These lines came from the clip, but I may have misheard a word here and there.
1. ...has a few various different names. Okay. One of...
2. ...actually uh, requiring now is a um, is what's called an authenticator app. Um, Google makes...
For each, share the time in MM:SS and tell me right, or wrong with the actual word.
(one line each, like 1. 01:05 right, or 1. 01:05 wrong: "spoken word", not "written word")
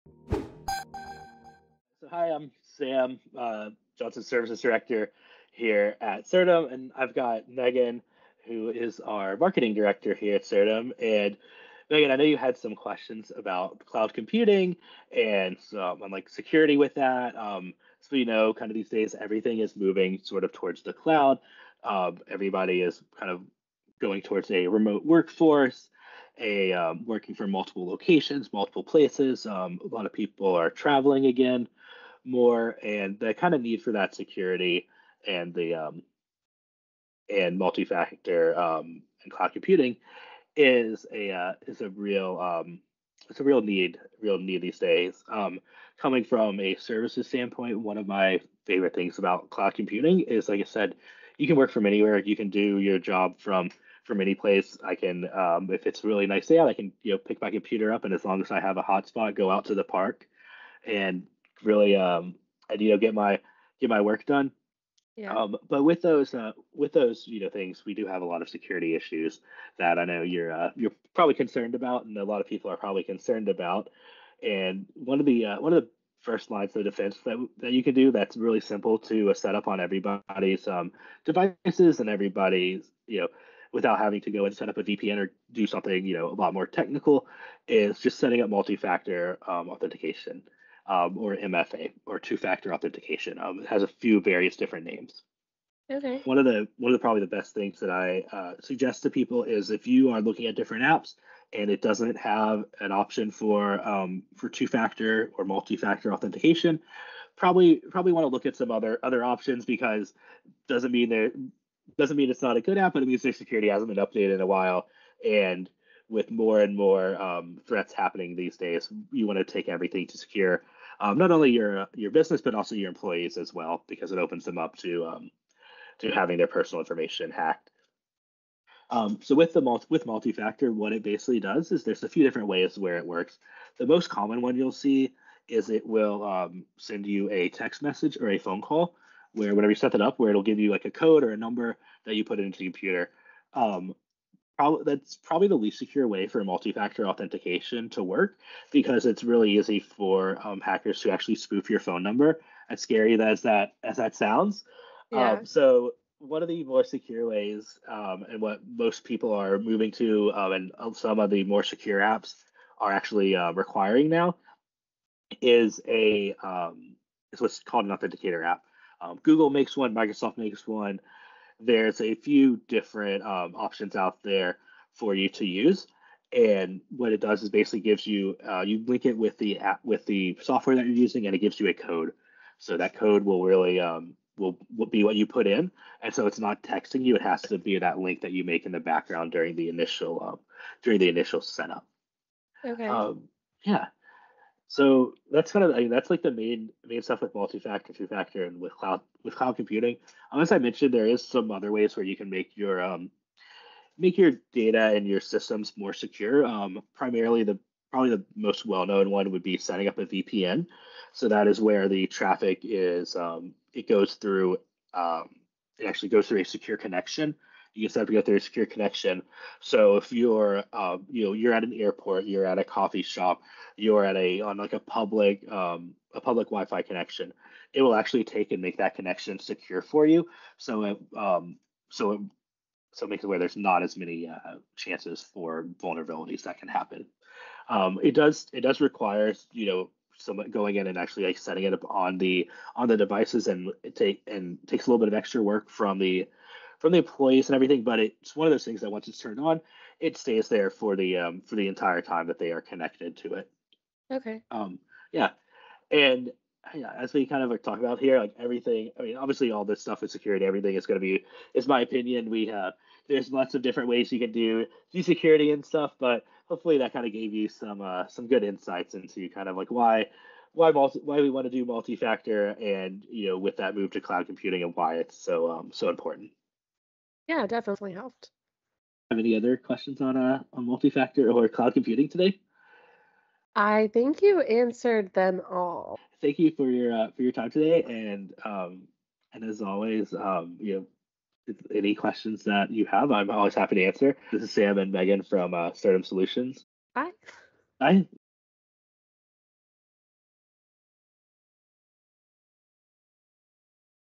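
1. 01:33 right
2. 02:42 right.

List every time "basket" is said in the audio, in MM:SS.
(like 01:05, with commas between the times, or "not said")
not said.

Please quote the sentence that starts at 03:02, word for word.
So that code will really um, will, will be what you put in, and so it's not texting you.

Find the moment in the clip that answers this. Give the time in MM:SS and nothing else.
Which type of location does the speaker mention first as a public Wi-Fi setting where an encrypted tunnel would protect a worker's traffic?
03:41.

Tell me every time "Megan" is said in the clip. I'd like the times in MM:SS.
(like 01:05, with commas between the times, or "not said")
00:07, 00:11, 04:54.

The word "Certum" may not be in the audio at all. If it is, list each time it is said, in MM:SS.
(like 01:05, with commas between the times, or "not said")
00:06, 00:10, 04:55.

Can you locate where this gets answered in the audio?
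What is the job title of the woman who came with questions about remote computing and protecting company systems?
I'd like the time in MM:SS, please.
00:09.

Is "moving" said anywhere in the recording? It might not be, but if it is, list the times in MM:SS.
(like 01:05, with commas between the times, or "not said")
00:19, 02:39.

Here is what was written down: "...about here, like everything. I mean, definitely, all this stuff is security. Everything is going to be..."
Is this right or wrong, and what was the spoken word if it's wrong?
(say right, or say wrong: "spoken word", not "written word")
wrong: "obviously", not "definitely".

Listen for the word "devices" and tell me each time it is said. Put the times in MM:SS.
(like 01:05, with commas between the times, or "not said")
01:21, 04:02.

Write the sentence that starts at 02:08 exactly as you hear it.
Um, so with the multi, with multi-factor, what it basically does is there's a few different ways where it works.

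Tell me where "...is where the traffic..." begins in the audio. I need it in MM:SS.
03:31.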